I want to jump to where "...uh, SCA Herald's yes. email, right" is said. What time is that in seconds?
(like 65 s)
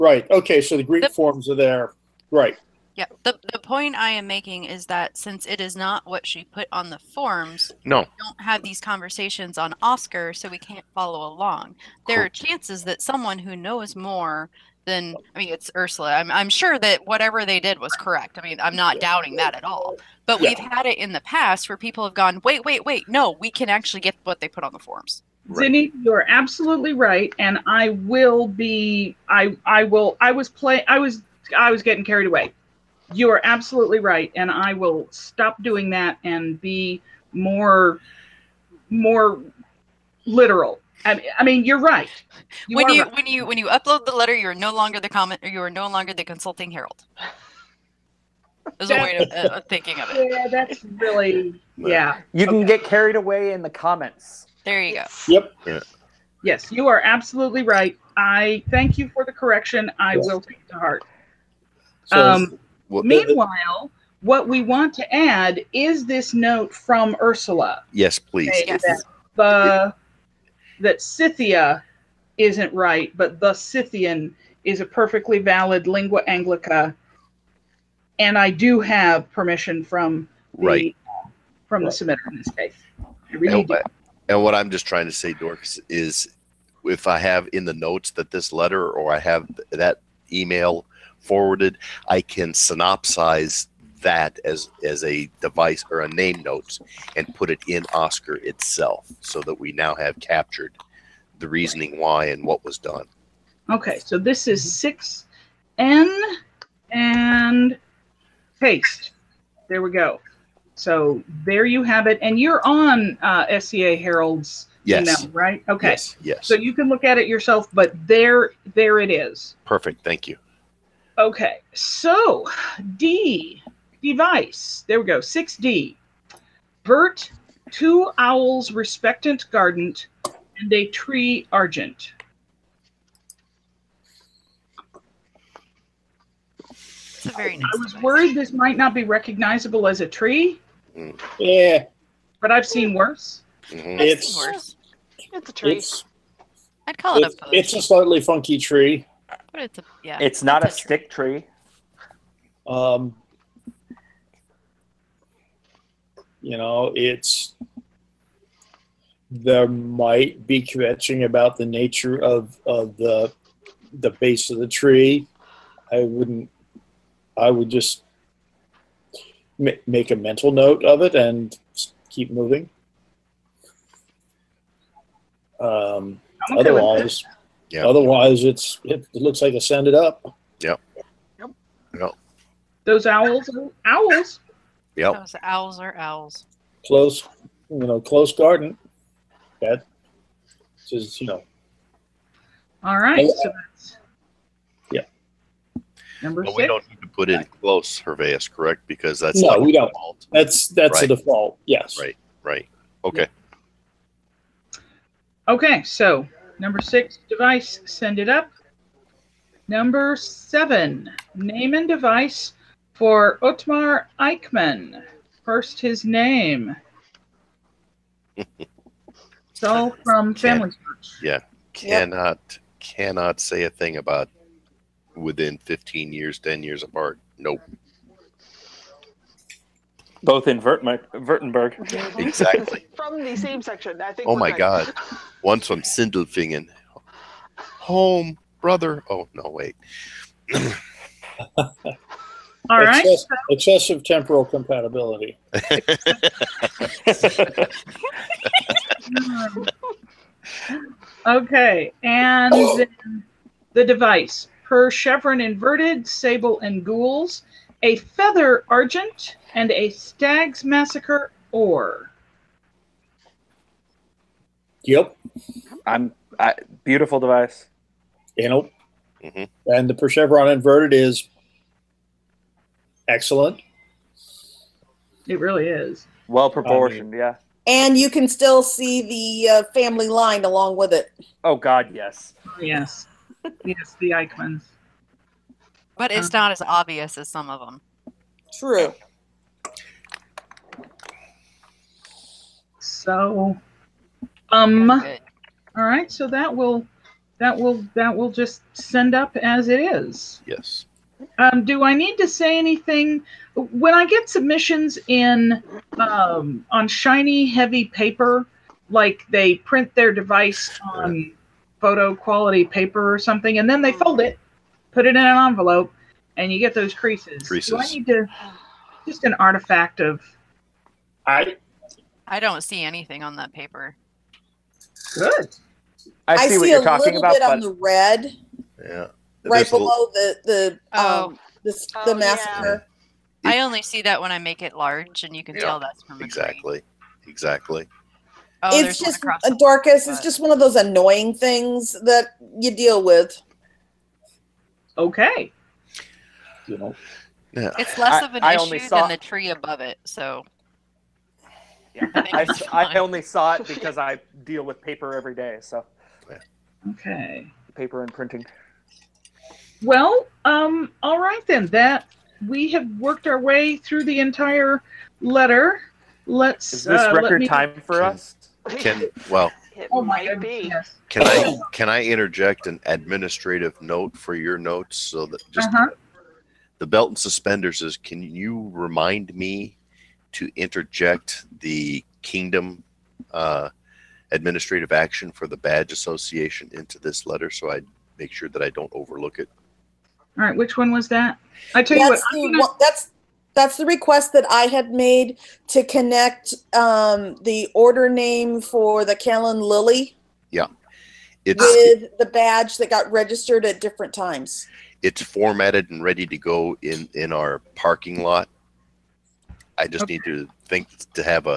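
113 s.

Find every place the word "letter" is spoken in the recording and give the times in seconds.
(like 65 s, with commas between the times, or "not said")
44 s, 88 s, 365 s, 387 s.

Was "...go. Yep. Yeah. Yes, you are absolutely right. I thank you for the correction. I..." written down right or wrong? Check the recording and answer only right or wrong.
right.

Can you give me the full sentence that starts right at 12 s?
There are chances that someone who knows more than, I mean, it's Ursula.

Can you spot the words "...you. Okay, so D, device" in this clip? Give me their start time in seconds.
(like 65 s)
120 s.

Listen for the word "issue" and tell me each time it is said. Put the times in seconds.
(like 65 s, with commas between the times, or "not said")
348 s.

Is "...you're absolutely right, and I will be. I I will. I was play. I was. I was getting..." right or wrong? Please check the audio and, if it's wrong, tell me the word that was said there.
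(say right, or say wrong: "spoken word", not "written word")
right.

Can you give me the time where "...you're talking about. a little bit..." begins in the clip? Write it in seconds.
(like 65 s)
326 s.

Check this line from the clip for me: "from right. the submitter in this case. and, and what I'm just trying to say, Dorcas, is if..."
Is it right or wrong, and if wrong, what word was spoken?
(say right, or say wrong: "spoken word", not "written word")
right.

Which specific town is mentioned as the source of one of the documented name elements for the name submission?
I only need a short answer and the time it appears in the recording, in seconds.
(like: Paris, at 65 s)
Sindelfingen, at 235 s.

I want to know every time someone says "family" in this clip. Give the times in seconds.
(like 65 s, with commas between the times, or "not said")
220 s, 279 s.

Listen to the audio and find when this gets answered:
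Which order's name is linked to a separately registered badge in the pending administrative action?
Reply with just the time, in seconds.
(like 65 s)
399 s.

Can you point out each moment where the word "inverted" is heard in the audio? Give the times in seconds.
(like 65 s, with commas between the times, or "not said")
255 s, 270 s.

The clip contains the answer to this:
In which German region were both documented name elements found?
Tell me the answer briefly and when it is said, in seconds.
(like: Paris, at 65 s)
Württemberg, at 231 s.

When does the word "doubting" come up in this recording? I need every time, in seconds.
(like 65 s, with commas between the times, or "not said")
19 s.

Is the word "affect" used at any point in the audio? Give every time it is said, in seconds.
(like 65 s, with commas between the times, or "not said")
not said.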